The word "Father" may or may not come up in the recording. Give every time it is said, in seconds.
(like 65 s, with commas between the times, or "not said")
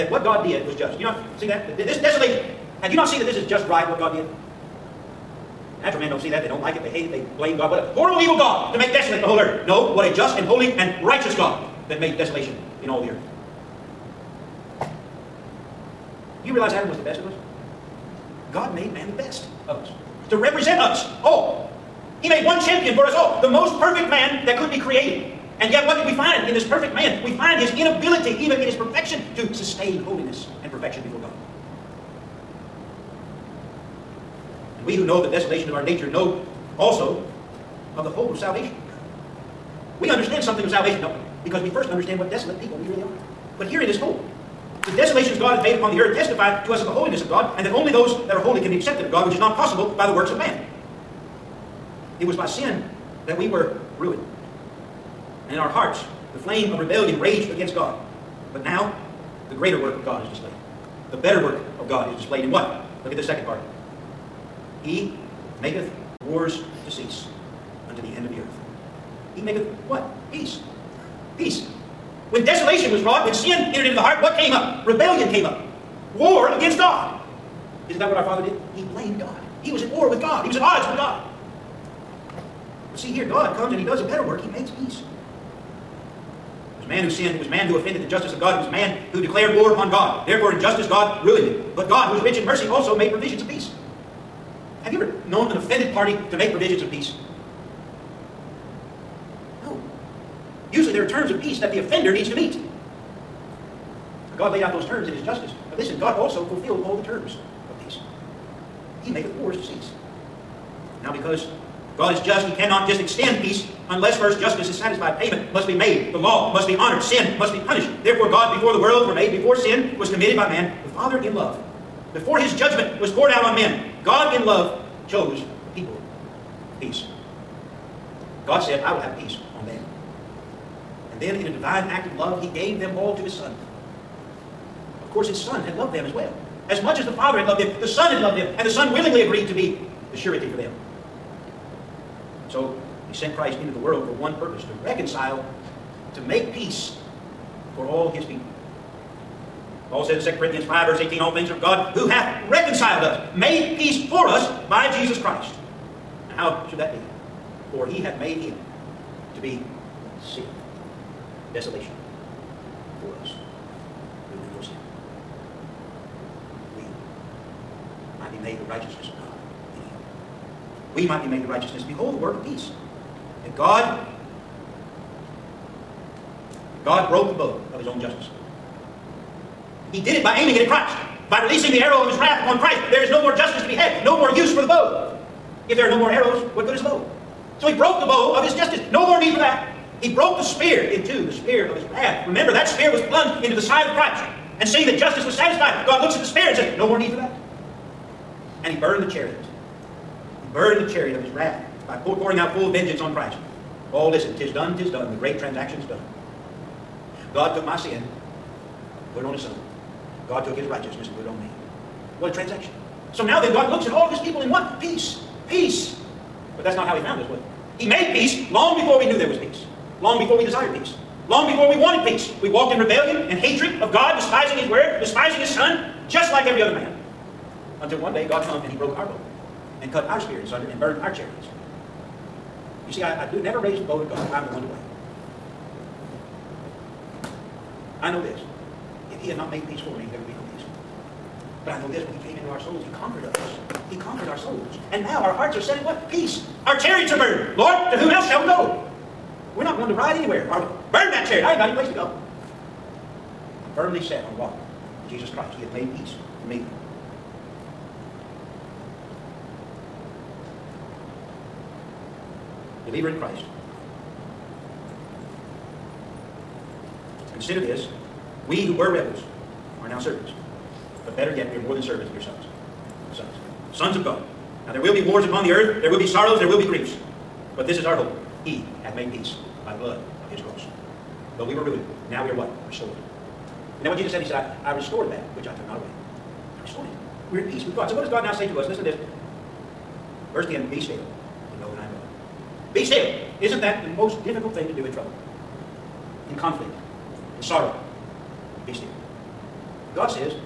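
78 s, 120 s, 137 s.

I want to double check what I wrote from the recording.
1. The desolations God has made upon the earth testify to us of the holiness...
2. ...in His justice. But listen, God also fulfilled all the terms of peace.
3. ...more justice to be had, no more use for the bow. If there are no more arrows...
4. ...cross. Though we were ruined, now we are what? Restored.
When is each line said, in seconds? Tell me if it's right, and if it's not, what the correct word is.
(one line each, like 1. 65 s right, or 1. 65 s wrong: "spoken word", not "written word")
1. 44 s right
2. 105 s right
3. 183 s right
4. 280 s right.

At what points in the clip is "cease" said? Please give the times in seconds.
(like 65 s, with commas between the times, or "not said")
66 s, 109 s.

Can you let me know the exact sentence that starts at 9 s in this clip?
No, what a just and holy and righteous God that made desolation in all the earth.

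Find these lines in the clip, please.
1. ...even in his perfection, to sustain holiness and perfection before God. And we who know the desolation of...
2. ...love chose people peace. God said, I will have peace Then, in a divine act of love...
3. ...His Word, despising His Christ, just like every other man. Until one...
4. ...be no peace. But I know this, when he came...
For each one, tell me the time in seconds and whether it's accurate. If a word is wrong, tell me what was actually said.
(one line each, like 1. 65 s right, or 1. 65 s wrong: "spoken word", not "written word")
1. 28 s right
2. 124 s right
3. 224 s wrong: "Son", not "Christ"
4. 240 s right.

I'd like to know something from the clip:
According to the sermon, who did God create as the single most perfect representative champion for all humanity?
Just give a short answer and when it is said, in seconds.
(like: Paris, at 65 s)
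Adam, at 16 s.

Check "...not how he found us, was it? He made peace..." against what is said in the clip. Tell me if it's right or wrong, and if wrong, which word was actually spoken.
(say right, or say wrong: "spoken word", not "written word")
right.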